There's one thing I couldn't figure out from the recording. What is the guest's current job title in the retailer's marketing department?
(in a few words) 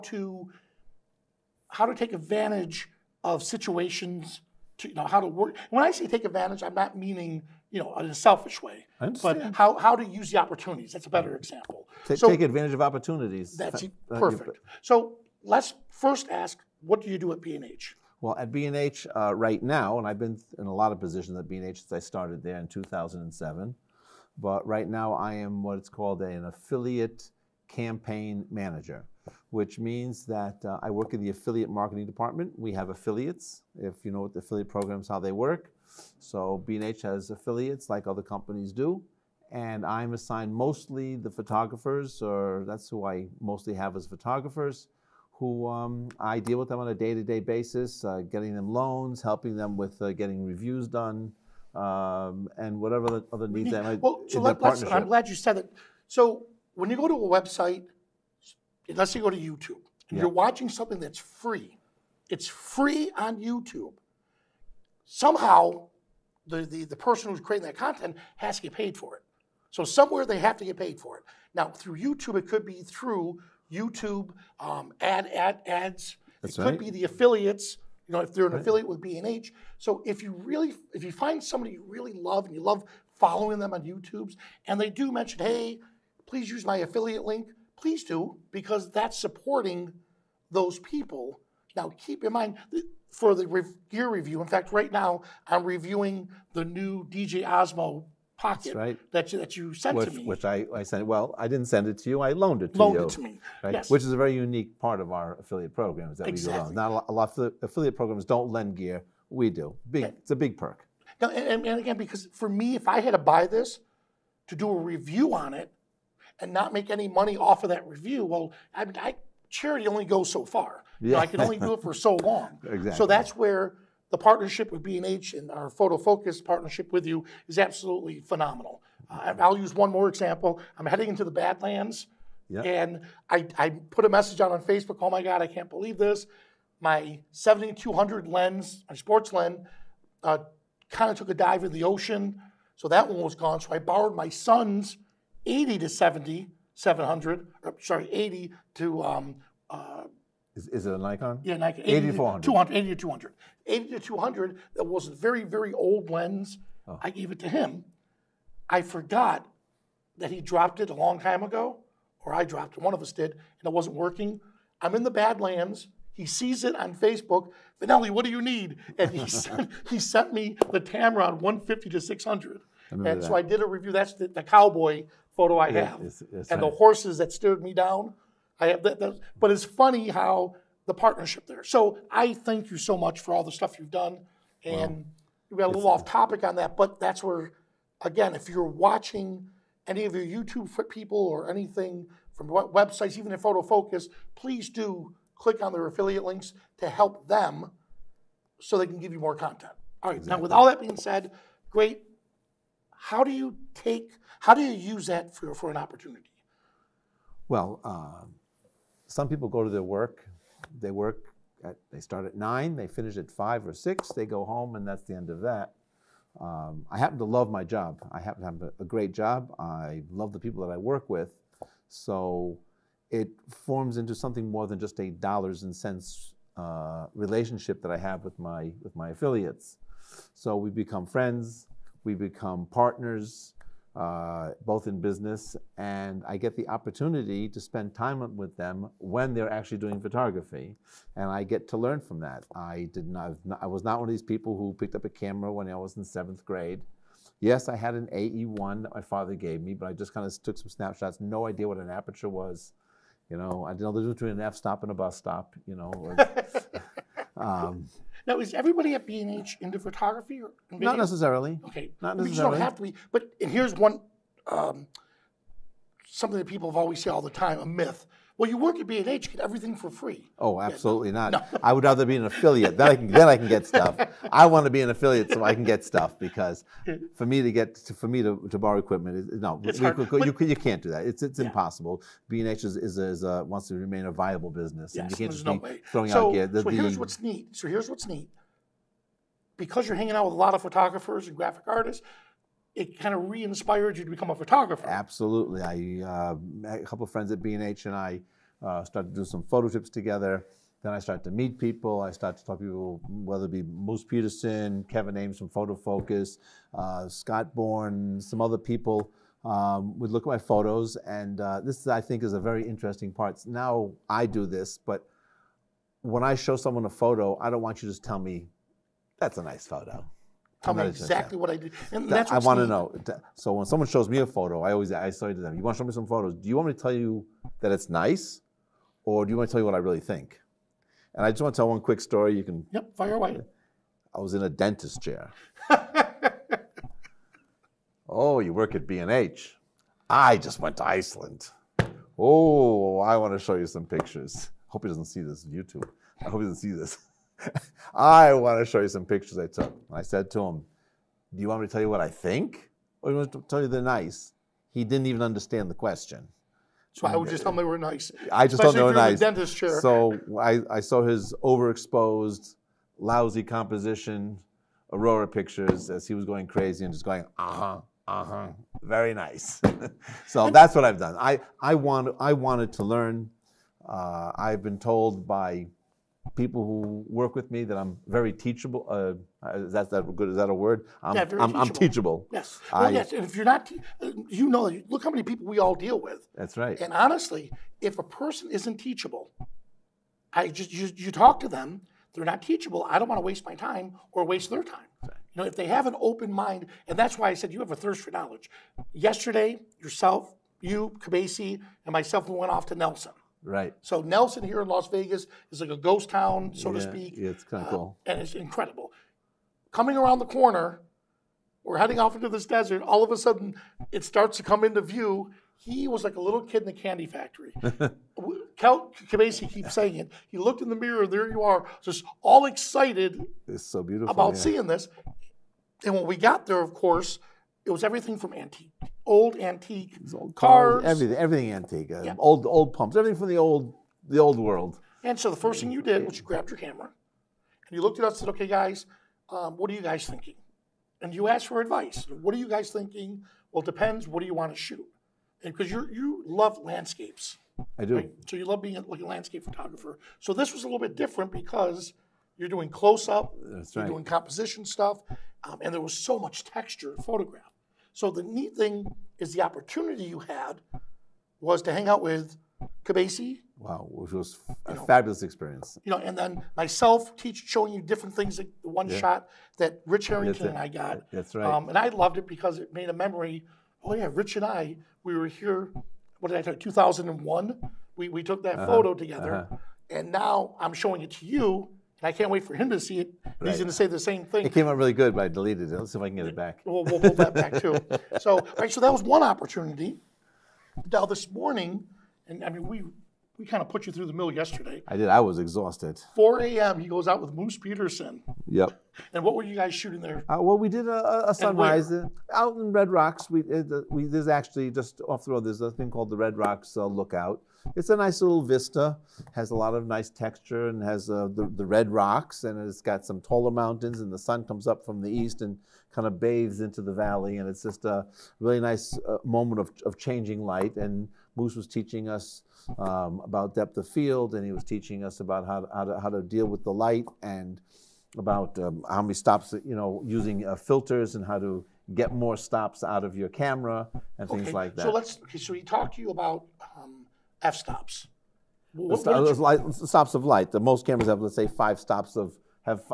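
affiliate campaign manager.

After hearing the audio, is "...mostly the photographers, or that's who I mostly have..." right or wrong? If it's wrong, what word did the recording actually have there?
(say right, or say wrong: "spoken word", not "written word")
right.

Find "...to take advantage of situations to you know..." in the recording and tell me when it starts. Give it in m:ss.
0:01.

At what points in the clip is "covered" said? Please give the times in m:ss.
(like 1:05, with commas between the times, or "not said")
not said.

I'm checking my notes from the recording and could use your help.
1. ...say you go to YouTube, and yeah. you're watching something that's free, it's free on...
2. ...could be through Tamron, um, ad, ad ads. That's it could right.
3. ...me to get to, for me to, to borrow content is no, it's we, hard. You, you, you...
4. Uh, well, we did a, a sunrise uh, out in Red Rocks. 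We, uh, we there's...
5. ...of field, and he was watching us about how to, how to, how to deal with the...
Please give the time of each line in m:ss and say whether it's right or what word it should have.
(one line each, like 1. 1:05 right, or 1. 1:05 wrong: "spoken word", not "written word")
1. 0:59 right
2. 1:12 wrong: "YouTube", not "Tamron"
3. 4:37 wrong: "equipment", not "content"
4. 8:20 right
5. 8:43 wrong: "teaching", not "watching".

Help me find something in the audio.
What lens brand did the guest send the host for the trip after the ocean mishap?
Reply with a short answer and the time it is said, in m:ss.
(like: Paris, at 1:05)
Tamron, at 2:50.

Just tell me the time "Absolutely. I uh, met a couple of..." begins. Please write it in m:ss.
4:54.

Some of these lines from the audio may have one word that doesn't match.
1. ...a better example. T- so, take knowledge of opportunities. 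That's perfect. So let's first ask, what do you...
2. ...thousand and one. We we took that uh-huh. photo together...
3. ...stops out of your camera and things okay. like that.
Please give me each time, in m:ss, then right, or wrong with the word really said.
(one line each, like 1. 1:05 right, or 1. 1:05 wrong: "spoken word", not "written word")
1. 0:11 wrong: "advantage", not "knowledge"
2. 7:56 right
3. 8:52 right.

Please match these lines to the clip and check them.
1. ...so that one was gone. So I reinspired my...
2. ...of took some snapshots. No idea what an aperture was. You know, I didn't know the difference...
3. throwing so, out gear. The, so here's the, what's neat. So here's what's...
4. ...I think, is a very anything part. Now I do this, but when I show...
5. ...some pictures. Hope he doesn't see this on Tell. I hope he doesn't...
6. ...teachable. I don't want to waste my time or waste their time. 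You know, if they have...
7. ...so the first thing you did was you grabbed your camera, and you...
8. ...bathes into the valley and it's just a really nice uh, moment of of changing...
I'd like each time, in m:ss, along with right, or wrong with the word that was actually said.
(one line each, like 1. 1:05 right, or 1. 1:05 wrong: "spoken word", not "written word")
1. 2:22 wrong: "borrowed", not "reinspired"
2. 4:10 right
3. 4:45 right
4. 5:11 wrong: "interesting", not "anything"
5. 5:43 wrong: "YouTube", not "Tell"
6. 6:32 right
7. 7:15 right
8. 8:36 right.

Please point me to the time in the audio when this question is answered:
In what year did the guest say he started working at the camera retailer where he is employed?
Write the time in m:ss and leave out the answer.
0:22.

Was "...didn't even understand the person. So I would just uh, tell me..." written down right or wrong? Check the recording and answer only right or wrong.
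wrong.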